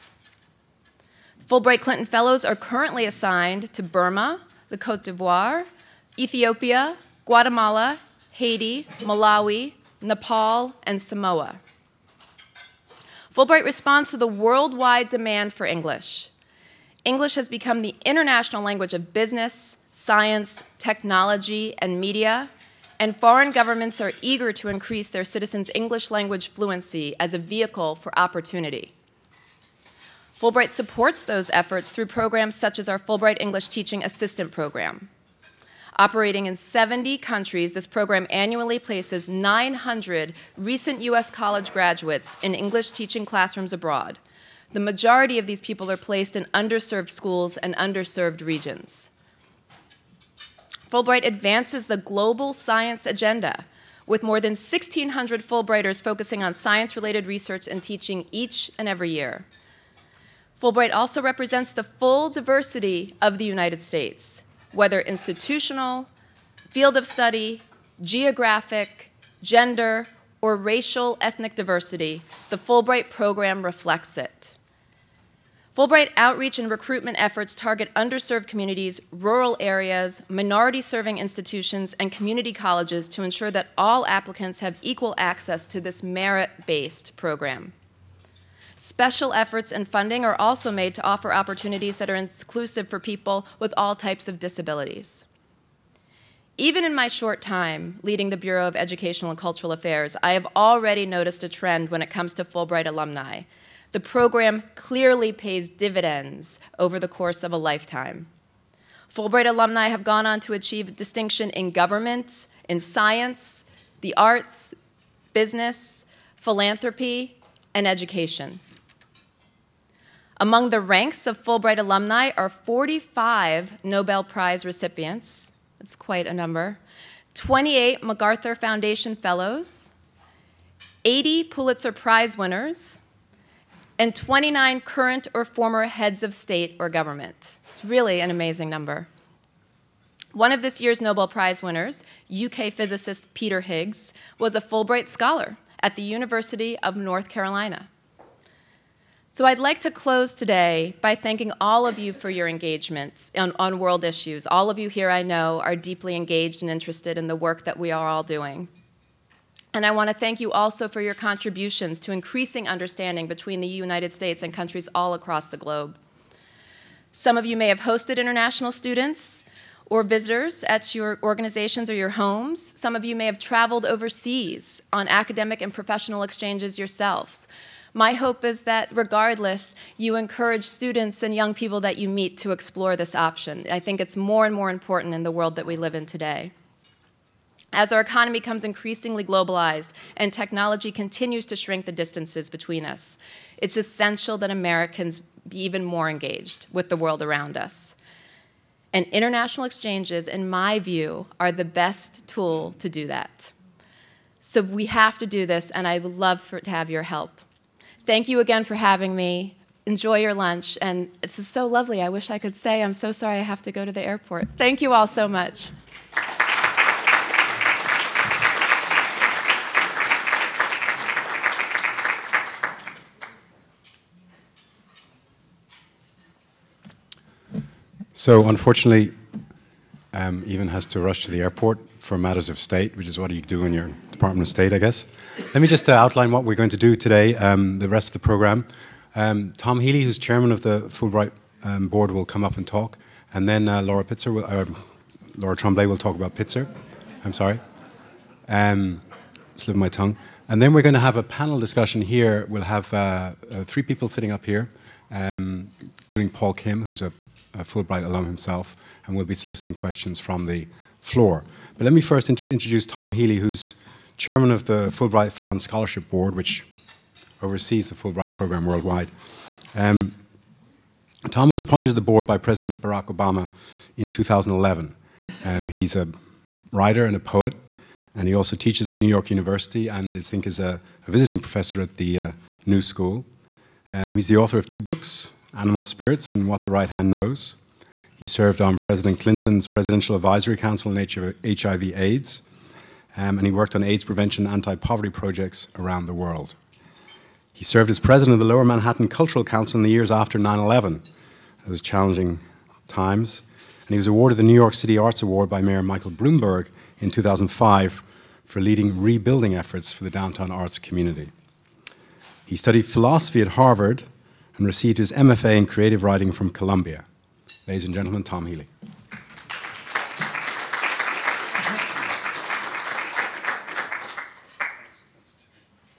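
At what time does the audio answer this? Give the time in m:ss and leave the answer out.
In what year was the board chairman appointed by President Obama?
4:34.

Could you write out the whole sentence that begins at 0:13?
Fulbright responds to the worldwide demand for English.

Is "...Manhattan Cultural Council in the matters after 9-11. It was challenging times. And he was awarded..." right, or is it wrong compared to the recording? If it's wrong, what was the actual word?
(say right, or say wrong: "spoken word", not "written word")
wrong: "years", not "matters".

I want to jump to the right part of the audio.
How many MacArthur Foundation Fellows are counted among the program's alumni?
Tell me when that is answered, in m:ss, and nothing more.
2:07.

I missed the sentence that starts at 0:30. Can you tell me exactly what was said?
Fulbright supports those efforts through programs such as our Fulbright English Teaching Assistant Program.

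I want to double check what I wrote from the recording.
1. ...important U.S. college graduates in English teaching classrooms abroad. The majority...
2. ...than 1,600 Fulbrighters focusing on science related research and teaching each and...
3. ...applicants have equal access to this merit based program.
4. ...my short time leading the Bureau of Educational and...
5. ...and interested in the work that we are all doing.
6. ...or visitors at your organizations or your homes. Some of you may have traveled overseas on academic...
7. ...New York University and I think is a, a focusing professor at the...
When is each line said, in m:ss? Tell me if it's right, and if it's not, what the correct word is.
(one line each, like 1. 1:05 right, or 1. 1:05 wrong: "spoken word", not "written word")
1. 0:40 wrong: "recent", not "important"
2. 0:54 right
3. 1:24 right
4. 1:36 right
5. 2:36 right
6. 2:49 right
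7. 4:38 wrong: "visiting", not "focusing".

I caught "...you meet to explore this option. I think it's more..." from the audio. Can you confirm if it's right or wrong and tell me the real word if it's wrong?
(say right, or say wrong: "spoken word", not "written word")
right.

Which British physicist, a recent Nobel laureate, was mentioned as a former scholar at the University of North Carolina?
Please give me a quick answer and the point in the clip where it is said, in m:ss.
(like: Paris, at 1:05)
Peter Higgs, at 2:23.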